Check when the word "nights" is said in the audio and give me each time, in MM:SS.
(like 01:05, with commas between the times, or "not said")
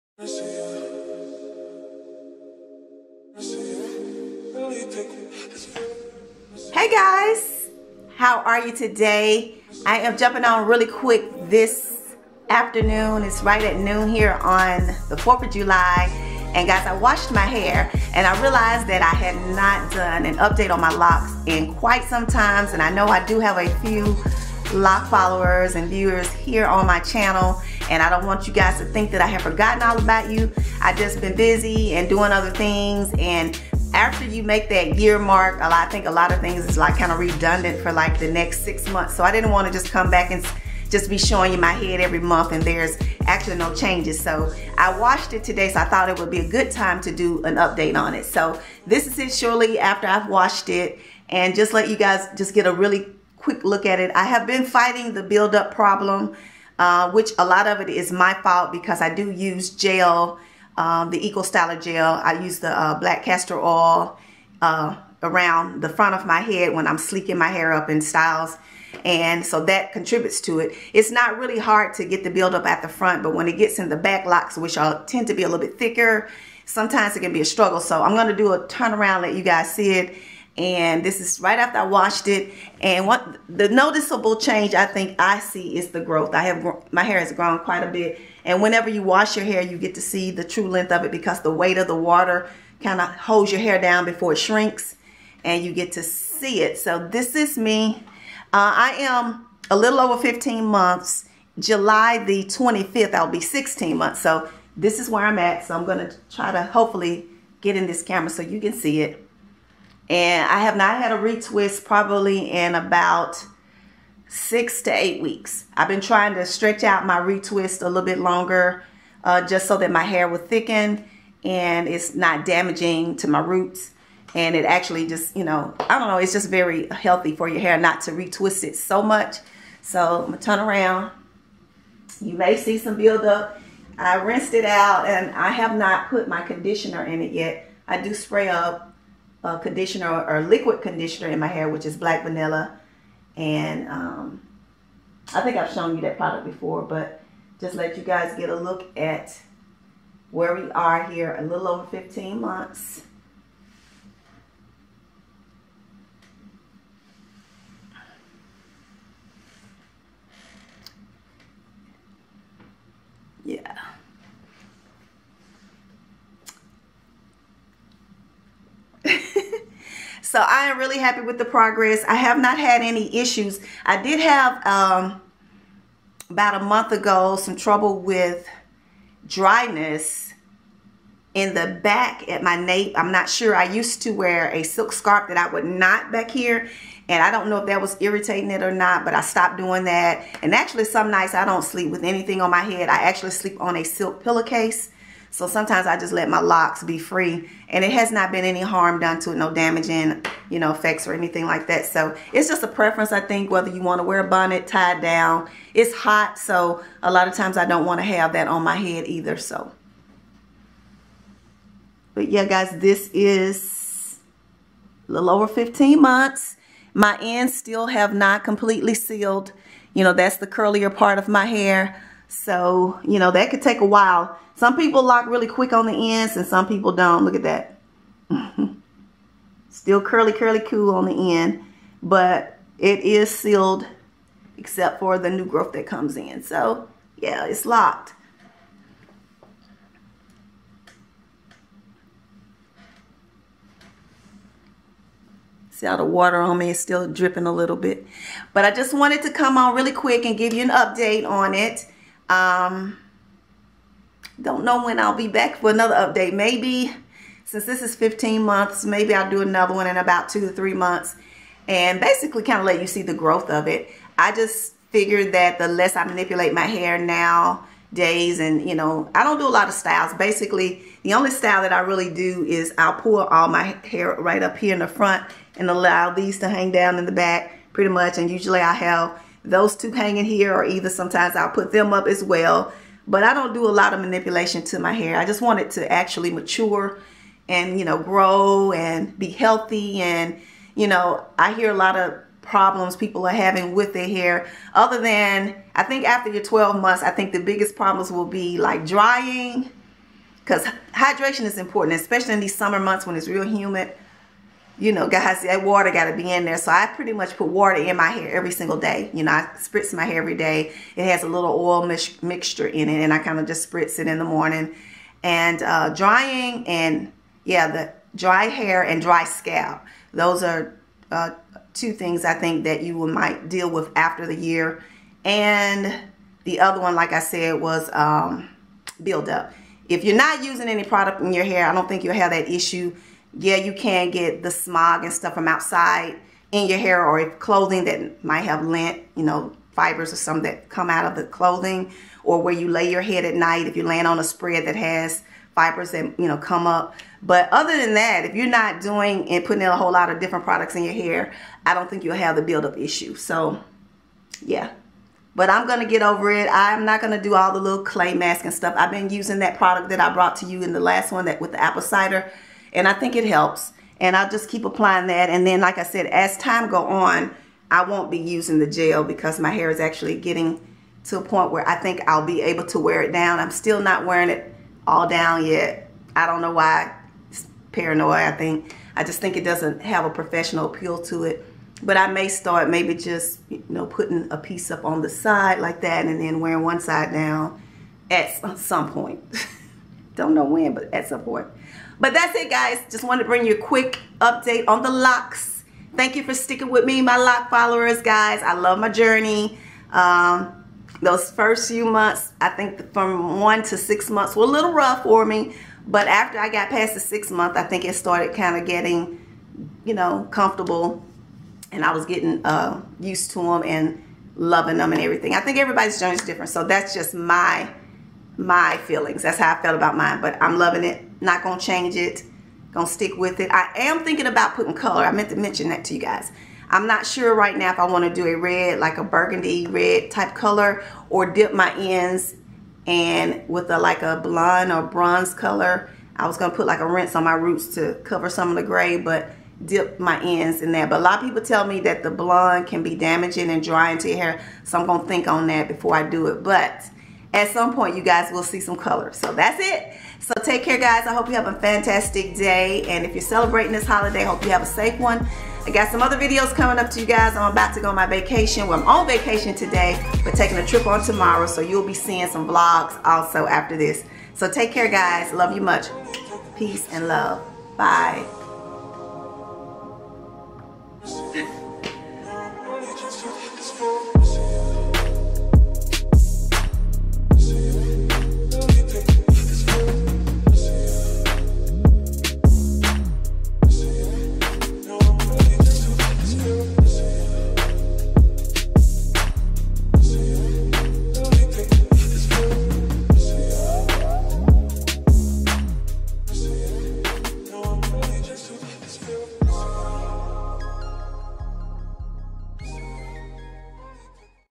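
03:11, 05:43.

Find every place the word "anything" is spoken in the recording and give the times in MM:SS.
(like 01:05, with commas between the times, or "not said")
03:12, 03:21.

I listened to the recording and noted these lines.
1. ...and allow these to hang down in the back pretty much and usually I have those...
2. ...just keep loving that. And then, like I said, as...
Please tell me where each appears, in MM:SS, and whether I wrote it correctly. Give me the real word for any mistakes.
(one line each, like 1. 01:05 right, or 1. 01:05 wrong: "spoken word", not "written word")
1. 04:35 right
2. 06:04 wrong: "applying", not "loving".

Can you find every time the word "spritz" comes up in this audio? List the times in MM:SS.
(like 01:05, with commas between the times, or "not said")
05:09, 05:13.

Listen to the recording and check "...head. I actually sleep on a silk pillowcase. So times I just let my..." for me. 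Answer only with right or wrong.
wrong.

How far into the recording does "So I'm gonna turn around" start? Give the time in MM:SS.
02:09.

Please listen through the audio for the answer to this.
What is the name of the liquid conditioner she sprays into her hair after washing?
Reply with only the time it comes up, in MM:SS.
02:21.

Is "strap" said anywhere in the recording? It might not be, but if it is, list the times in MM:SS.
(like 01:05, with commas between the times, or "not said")
not said.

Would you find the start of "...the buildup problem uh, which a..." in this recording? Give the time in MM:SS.
00:55.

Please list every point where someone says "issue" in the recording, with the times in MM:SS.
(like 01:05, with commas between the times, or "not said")
02:53, 05:32, 05:52.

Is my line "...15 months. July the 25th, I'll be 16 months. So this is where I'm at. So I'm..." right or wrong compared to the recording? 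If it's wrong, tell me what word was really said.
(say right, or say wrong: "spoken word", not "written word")
right.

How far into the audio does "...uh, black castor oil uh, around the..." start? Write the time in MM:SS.
01:02.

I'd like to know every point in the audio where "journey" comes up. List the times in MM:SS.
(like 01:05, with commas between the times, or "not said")
06:38, 06:55.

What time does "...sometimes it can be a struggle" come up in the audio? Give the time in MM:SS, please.
01:16.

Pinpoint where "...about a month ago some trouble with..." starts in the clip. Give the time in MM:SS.
02:56.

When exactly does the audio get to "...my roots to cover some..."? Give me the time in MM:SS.
07:17.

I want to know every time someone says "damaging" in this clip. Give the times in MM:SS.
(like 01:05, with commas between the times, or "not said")
02:02, 03:19, 07:22.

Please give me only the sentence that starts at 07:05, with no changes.
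I meant to mention that to you guys.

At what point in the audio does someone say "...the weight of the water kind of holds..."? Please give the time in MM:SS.
01:31.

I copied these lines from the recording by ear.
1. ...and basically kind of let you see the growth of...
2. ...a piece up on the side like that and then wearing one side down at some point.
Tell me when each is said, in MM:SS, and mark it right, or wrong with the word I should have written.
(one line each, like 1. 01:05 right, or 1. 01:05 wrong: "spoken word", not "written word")
1. 04:21 right
2. 06:24 right.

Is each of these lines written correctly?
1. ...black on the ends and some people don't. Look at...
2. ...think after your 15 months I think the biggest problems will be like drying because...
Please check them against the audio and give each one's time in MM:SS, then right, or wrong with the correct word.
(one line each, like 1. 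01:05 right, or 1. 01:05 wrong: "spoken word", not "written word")
1. 03:45 wrong: "quick", not "black"
2. 04:55 wrong: "12", not "15".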